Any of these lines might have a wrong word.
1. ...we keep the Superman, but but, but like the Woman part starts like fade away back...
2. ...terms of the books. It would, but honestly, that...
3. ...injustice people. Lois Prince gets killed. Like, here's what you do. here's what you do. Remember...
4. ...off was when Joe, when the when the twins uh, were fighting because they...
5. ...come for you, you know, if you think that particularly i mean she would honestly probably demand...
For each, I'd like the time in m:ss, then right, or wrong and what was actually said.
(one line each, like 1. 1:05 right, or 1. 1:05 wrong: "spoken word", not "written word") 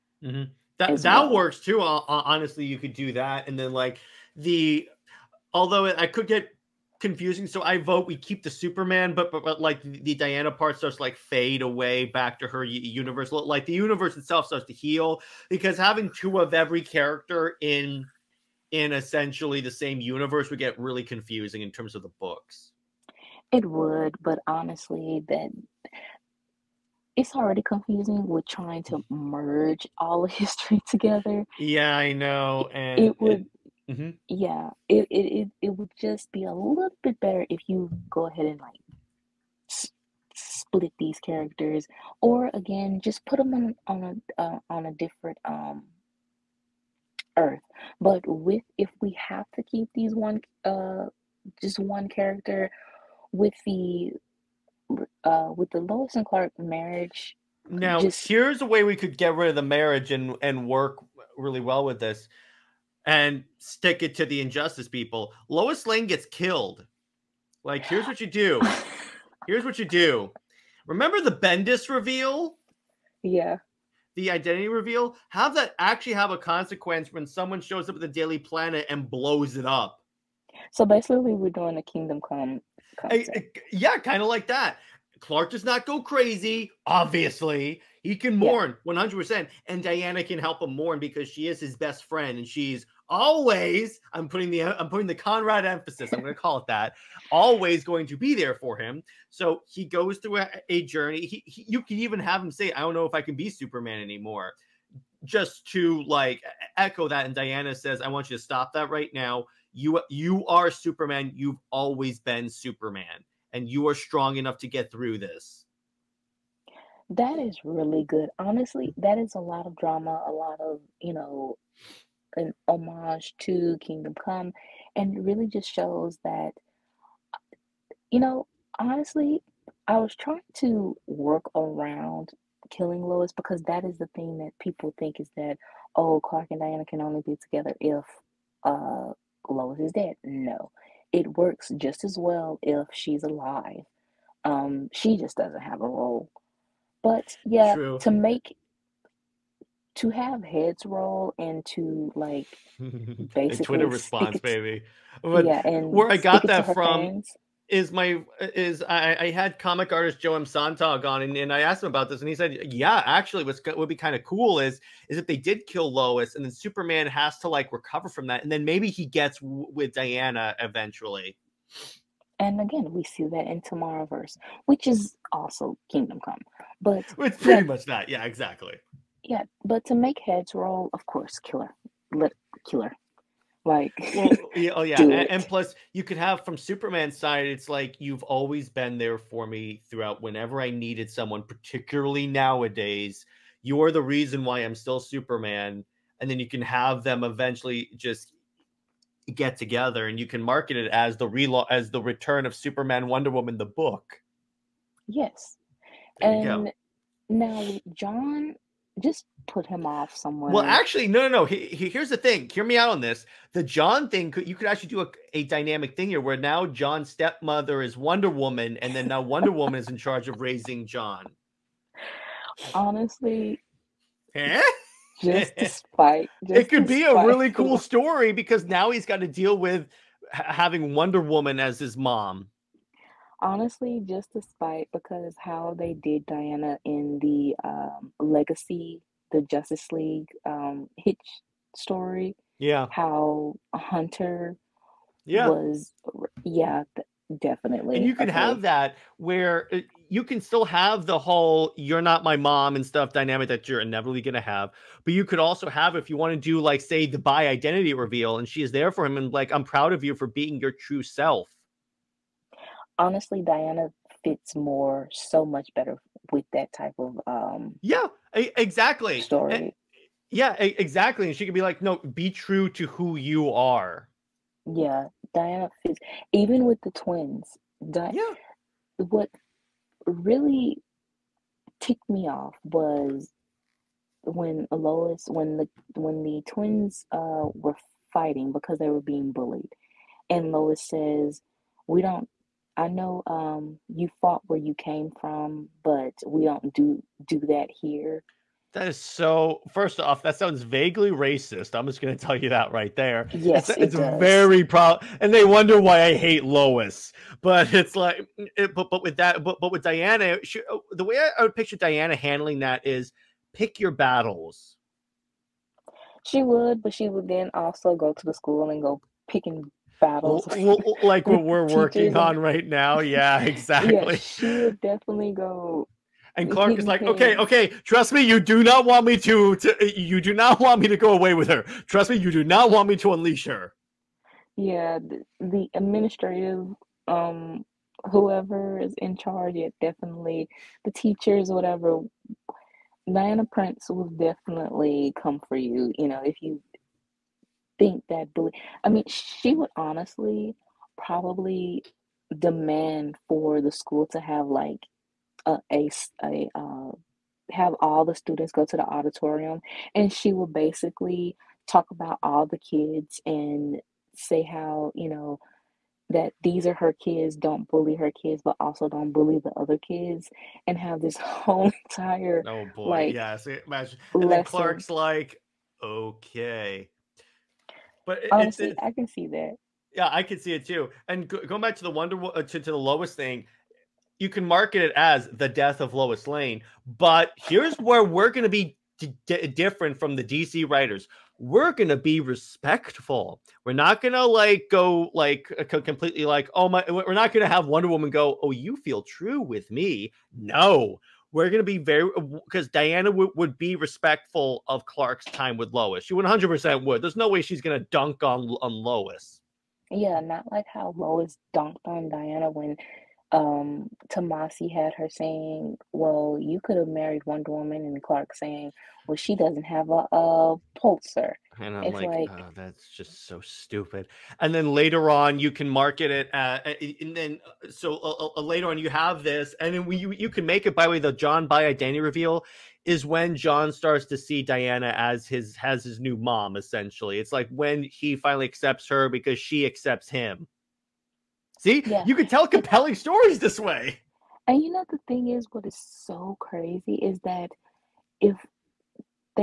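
1. 0:08 wrong: "Diana", not "Woman"
2. 0:21 right
3. 1:04 wrong: "Lane", not "Prince"
4. 4:42 wrong: "Lois", not "Joe"
5. 5:45 wrong: "bully", not "particularly".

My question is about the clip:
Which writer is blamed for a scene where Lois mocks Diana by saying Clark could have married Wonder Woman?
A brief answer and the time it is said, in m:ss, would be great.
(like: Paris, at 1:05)
Tomasi, at 6:54.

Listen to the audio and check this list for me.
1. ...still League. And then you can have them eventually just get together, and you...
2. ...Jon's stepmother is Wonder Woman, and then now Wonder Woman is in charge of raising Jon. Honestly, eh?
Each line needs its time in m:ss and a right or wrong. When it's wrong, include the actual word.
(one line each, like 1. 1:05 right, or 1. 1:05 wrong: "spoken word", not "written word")
1. 3:14 wrong: "Superman", not "League"
2. 3:36 right.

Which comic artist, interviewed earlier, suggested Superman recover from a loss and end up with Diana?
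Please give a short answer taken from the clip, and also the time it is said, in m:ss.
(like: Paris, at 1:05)
Joe M. Sontag, at 2:40.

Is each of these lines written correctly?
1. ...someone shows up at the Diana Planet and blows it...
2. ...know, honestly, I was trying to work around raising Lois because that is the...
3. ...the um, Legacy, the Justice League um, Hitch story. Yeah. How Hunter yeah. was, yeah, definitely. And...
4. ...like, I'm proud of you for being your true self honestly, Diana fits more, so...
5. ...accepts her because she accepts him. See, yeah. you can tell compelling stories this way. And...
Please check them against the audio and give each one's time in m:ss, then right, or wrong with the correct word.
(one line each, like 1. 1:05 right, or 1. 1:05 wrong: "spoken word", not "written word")
1. 1:17 wrong: "Daily", not "Diana"
2. 2:08 wrong: "killing", not "raising"
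3. 3:57 right
4. 4:19 right
5. 7:18 right.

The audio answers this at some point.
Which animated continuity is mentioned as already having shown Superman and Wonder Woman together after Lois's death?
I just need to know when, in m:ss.
2:53.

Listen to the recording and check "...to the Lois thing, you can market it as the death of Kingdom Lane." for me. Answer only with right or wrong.
wrong.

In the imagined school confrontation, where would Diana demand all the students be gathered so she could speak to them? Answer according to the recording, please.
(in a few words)
the auditorium.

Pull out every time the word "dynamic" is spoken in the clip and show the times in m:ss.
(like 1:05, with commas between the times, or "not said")
3:35, 4:13.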